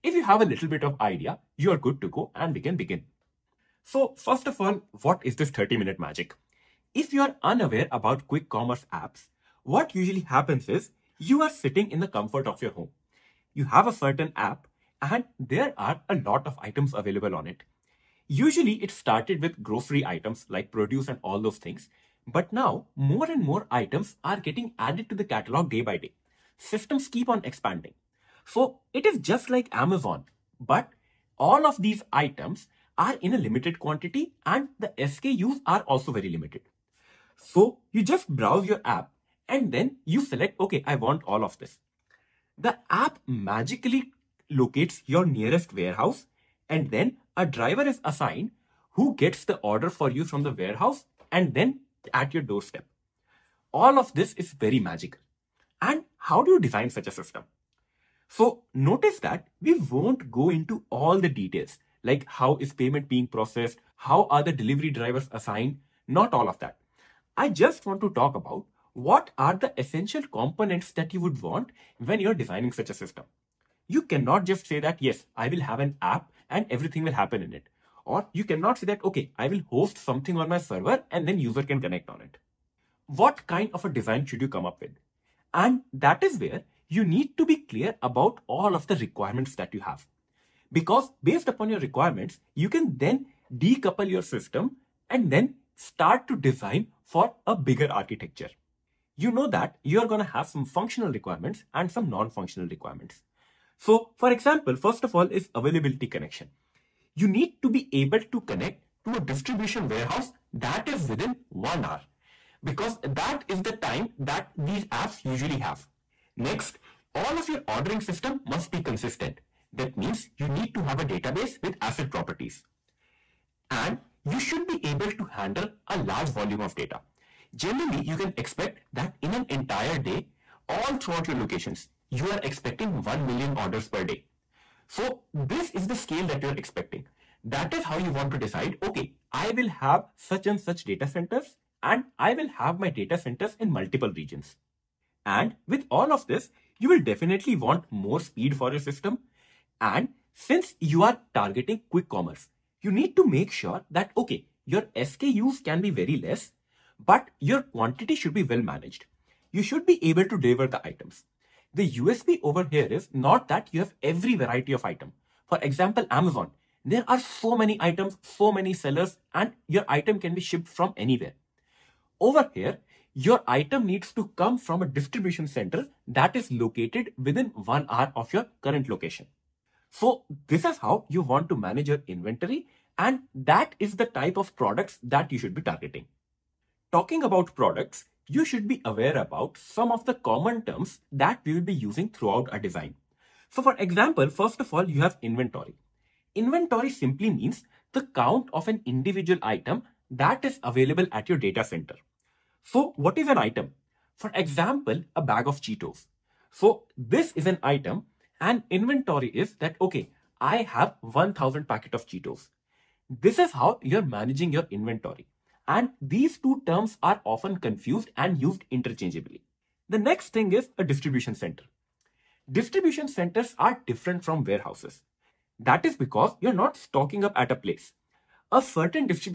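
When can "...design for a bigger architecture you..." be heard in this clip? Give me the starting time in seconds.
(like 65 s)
96 s.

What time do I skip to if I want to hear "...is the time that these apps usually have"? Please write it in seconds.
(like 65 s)
113 s.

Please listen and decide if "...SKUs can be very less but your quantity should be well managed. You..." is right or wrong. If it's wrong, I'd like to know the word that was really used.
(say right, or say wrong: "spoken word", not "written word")
right.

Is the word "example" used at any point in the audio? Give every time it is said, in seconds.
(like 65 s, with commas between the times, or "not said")
104 s, 165 s, 193 s, 204 s.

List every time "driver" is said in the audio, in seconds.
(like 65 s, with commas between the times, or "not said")
47 s, 64 s.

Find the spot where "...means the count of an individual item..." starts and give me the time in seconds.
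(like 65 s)
197 s.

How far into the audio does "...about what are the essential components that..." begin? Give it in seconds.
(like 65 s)
68 s.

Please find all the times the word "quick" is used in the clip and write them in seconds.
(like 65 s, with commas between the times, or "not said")
8 s, 151 s.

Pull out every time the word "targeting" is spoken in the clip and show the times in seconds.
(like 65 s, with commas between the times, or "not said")
151 s, 185 s.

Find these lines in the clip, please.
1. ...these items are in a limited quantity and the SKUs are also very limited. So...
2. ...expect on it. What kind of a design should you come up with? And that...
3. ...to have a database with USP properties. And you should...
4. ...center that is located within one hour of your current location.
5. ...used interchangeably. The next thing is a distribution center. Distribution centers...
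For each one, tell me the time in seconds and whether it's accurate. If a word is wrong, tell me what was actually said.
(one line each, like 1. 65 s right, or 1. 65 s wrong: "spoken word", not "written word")
1. 31 s right
2. 81 s wrong: "connect", not "expect"
3. 120 s wrong: "ACID", not "USP"
4. 175 s right
5. 218 s right.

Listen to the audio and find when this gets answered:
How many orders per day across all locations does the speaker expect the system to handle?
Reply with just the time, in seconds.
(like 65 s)
133 s.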